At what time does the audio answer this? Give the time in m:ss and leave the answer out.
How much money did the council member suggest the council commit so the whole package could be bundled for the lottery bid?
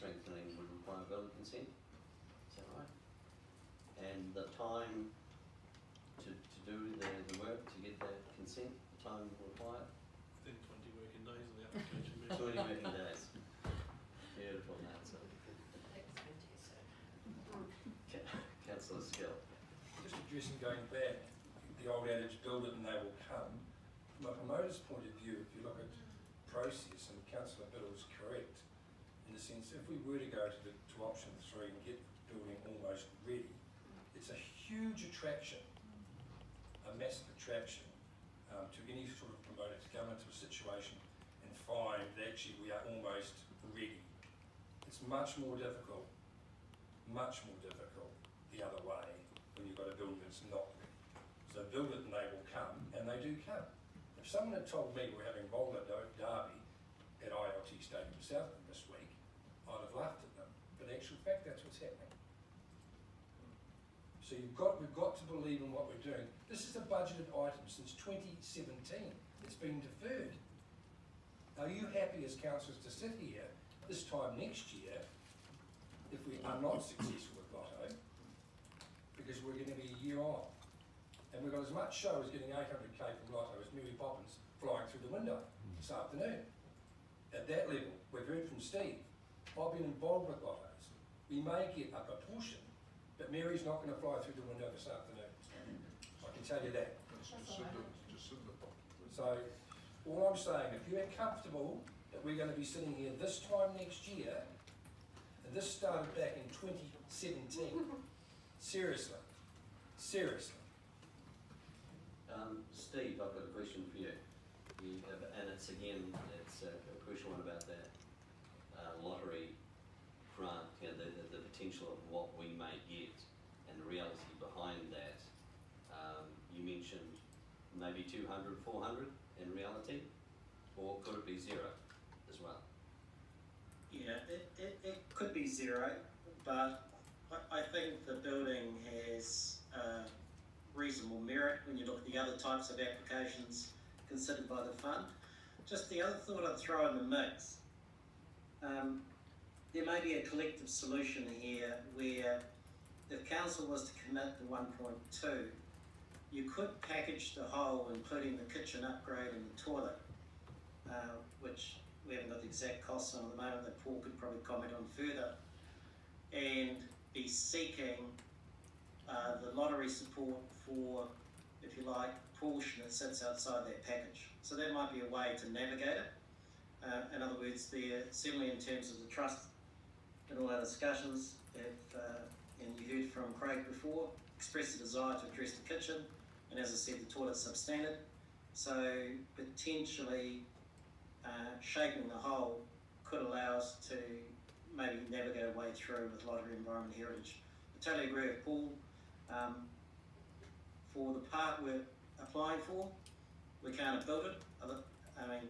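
2:34.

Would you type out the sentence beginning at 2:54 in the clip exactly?
So that might be a way to navigate it.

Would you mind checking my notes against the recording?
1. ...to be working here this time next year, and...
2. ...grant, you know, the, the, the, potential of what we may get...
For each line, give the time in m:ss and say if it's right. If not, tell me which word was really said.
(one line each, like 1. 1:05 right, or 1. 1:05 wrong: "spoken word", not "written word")
1. 1:42 wrong: "sitting", not "working"
2. 2:00 right.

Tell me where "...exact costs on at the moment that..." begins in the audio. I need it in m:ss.
2:42.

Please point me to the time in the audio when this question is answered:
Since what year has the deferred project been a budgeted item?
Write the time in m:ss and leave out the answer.
1:07.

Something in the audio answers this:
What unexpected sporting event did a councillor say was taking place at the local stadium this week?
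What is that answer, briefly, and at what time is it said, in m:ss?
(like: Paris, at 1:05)
Roller derby, at 0:55.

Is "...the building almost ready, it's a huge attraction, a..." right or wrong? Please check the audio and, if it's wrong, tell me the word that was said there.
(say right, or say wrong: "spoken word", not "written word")
right.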